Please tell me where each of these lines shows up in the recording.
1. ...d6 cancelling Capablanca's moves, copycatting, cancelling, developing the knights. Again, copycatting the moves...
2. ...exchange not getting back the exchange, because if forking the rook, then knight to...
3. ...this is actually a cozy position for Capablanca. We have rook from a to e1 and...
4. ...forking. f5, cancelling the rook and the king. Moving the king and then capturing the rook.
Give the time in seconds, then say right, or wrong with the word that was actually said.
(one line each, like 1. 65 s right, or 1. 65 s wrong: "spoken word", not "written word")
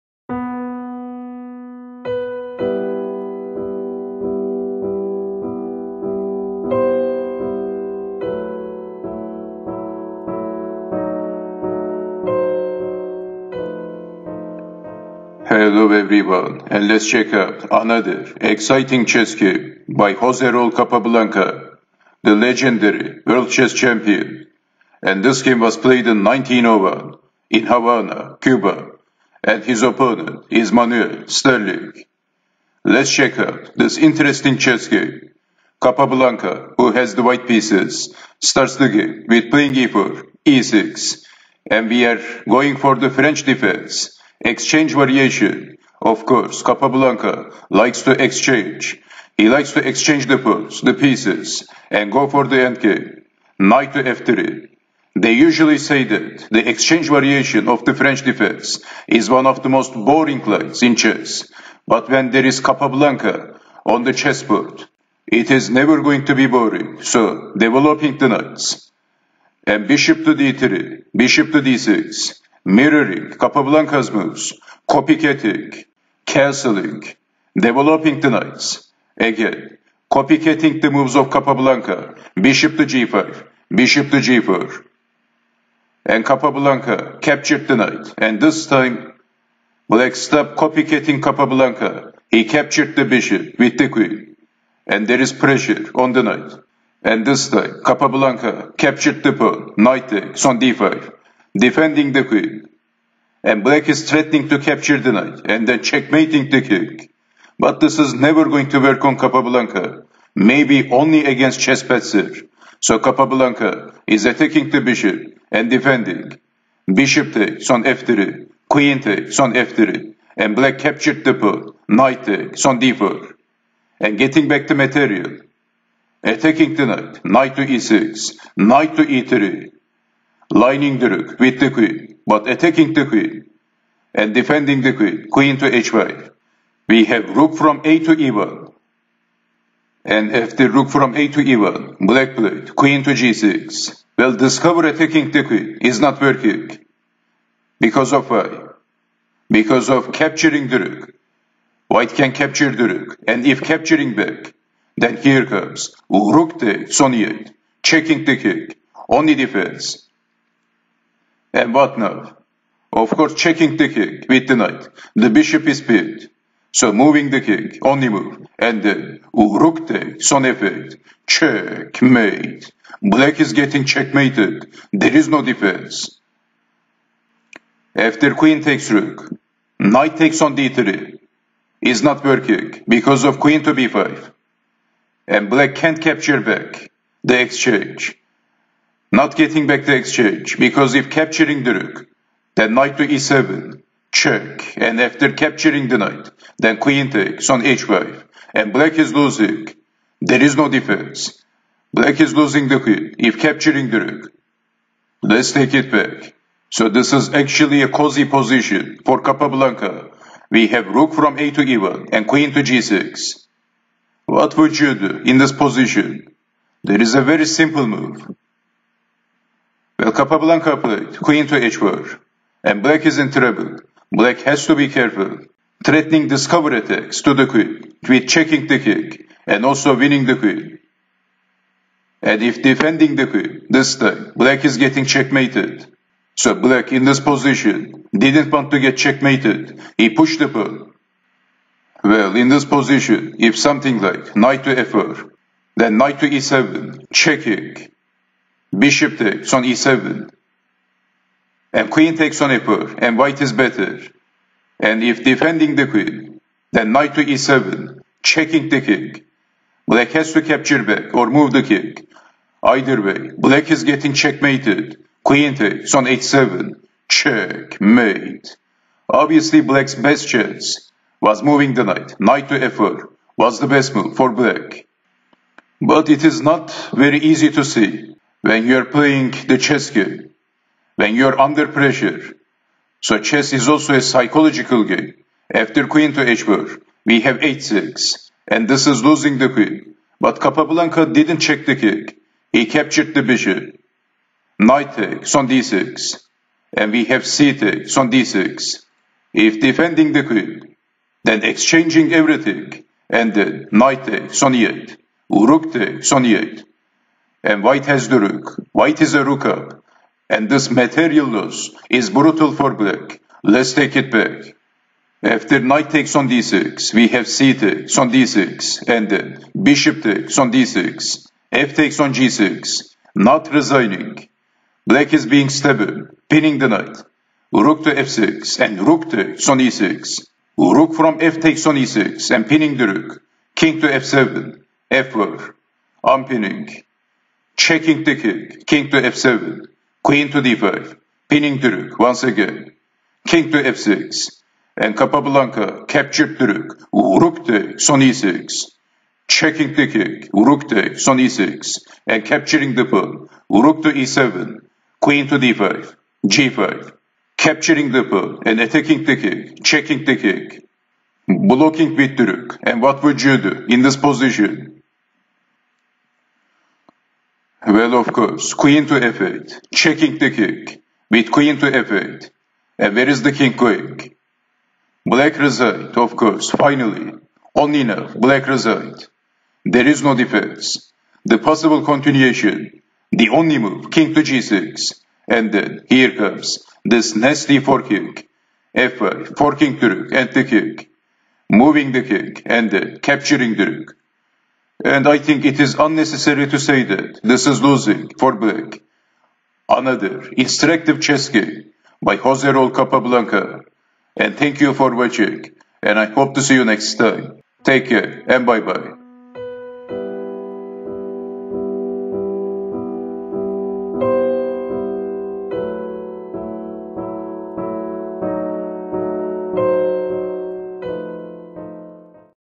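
1. 71 s wrong: "mirroring", not "cancelling"
2. 187 s wrong: "capturing", not "forking"
3. 206 s right
4. 387 s wrong: "forking", not "cancelling".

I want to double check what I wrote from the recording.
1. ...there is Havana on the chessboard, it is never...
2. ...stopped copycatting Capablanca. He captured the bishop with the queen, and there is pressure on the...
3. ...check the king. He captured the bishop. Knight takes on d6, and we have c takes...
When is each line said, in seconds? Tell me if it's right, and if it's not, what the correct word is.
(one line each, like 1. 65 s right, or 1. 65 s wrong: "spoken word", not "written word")
1. 62 s wrong: "Capablanca", not "Havana"
2. 90 s right
3. 291 s right.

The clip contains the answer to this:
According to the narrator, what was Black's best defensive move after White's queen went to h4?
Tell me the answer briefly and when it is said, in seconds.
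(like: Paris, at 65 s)
Knight to f4, at 272 s.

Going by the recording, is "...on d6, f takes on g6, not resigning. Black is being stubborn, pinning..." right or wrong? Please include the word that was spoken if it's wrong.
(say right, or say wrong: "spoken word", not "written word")
right.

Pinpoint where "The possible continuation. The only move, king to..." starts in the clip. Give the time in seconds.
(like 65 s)
381 s.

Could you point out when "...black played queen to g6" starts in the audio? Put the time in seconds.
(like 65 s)
141 s.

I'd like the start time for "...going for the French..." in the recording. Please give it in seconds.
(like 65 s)
42 s.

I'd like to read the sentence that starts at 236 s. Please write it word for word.
So black in this position didn't want to get checkmated.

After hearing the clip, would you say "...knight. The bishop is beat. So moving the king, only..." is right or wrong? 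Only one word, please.
right.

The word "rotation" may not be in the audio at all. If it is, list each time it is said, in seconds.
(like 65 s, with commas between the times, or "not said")
not said.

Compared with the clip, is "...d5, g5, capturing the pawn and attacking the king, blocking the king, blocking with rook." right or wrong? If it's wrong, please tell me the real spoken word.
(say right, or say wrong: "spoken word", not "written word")
wrong: "checking", not "blocking".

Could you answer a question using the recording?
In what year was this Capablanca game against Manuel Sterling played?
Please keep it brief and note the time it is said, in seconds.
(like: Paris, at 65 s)
1901, at 26 s.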